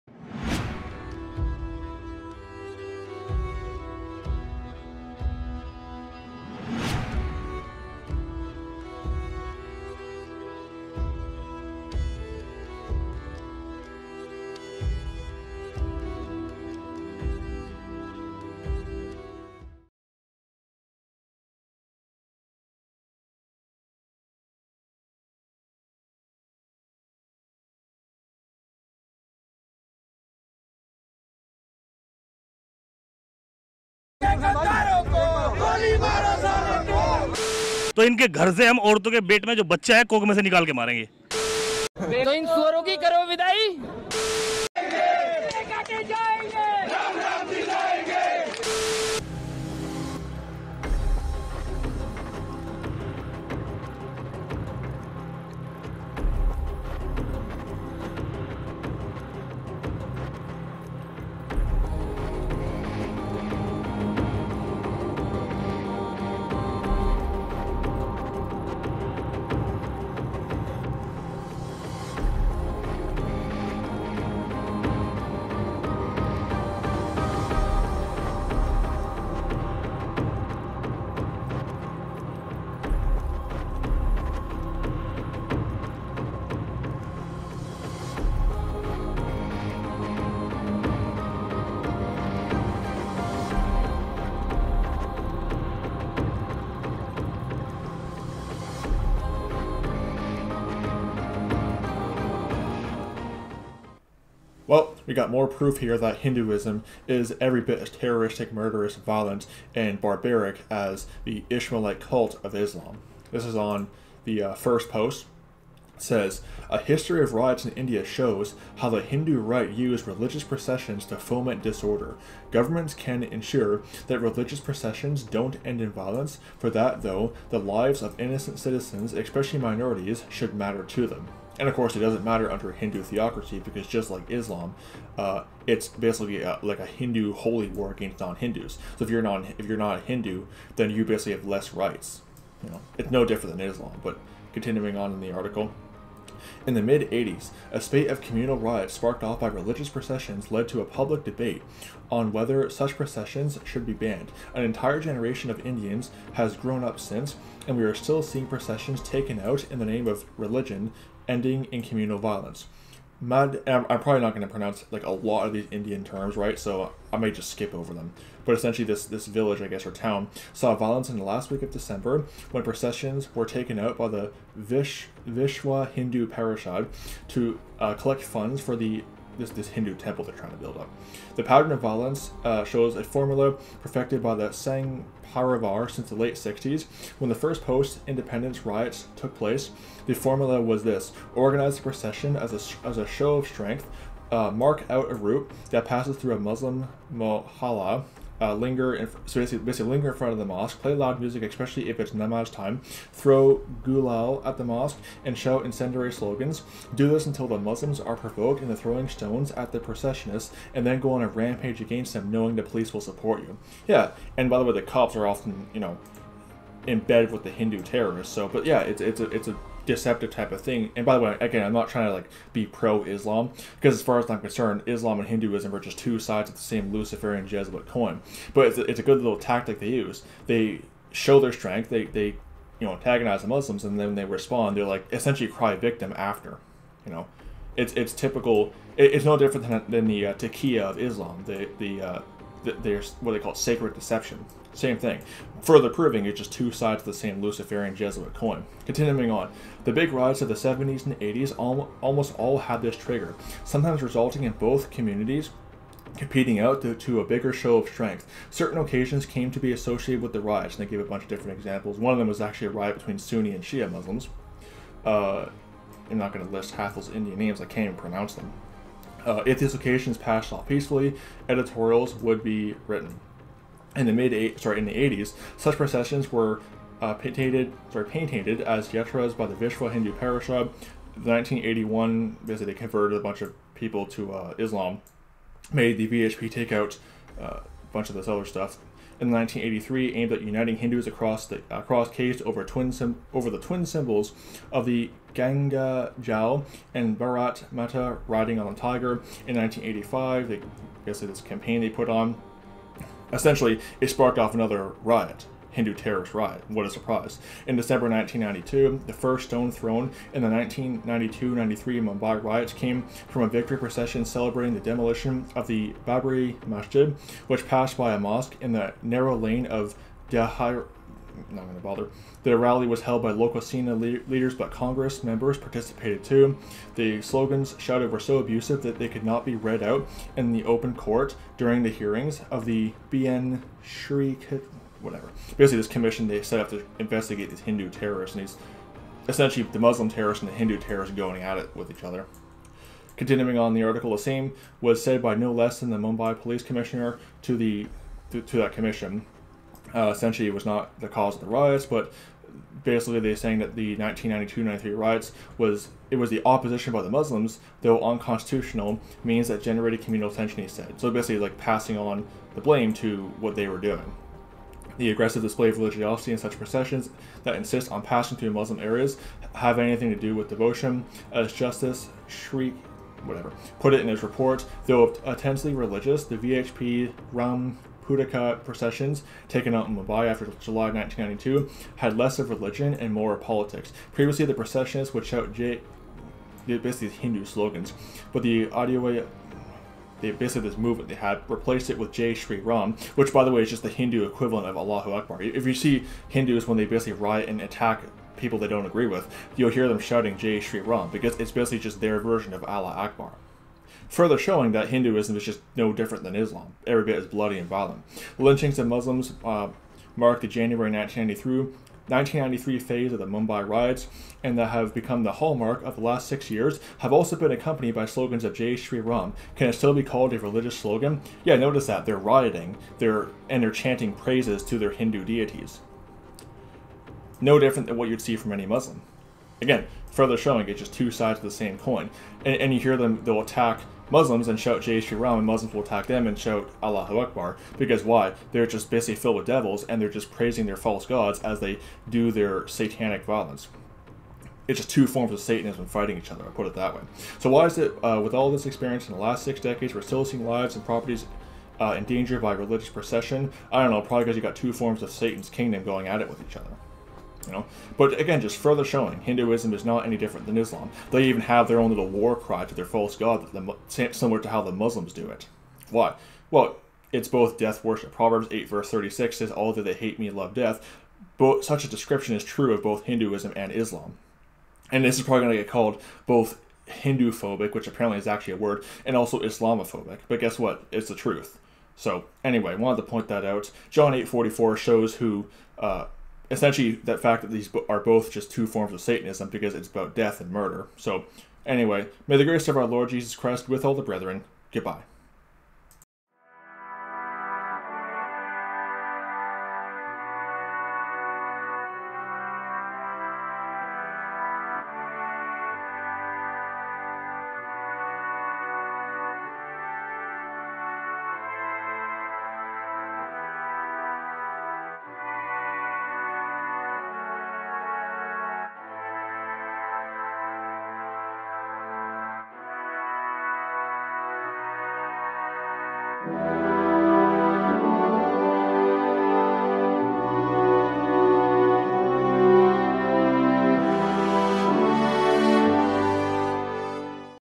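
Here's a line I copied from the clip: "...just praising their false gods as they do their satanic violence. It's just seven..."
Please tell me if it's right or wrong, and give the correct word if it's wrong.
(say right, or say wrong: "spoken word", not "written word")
wrong: "two", not "seven".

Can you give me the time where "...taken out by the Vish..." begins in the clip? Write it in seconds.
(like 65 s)
173 s.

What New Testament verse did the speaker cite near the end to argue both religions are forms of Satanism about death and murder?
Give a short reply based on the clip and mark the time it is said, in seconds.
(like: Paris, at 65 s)
John 8:44, at 483 s.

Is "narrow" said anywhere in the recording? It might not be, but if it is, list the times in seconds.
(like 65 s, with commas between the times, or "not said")
319 s.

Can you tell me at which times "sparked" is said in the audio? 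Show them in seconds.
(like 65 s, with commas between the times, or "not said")
148 s, 304 s.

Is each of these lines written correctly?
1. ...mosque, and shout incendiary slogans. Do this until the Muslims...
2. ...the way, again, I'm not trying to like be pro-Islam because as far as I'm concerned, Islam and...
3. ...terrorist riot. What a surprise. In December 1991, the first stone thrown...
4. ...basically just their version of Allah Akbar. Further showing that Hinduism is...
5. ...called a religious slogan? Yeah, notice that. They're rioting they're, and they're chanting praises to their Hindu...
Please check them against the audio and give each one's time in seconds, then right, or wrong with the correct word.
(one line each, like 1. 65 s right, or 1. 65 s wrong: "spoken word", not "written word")
1. 204 s right
2. 221 s right
3. 305 s wrong: "1992", not "1991"
4. 401 s right
5. 420 s right.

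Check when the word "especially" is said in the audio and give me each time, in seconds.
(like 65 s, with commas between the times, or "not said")
129 s, 201 s.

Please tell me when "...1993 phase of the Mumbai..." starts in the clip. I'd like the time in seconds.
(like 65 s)
412 s.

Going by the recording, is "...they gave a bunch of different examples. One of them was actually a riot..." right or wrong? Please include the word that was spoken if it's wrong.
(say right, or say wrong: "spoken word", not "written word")
right.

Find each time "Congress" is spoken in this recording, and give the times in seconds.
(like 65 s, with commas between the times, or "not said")
324 s.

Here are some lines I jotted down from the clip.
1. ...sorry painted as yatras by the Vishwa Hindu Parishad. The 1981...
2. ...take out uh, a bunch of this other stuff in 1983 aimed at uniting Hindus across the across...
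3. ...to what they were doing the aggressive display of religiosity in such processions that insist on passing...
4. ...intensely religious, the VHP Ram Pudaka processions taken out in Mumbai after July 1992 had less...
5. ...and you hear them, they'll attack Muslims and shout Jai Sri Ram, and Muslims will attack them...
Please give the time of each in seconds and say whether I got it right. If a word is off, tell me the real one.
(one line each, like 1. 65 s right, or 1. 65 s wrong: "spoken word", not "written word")
1. 277 s right
2. 286 s right
3. 362 s right
4. 375 s right
5. 432 s right.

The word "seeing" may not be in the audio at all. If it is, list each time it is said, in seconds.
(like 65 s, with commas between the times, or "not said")
158 s, 450 s.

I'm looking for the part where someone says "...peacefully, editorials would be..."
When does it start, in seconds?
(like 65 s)
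270 s.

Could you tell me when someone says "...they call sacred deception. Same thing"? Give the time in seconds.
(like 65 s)
243 s.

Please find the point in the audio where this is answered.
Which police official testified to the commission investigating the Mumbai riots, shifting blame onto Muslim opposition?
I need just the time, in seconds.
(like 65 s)
345 s.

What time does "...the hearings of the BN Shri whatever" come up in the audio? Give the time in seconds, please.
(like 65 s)
331 s.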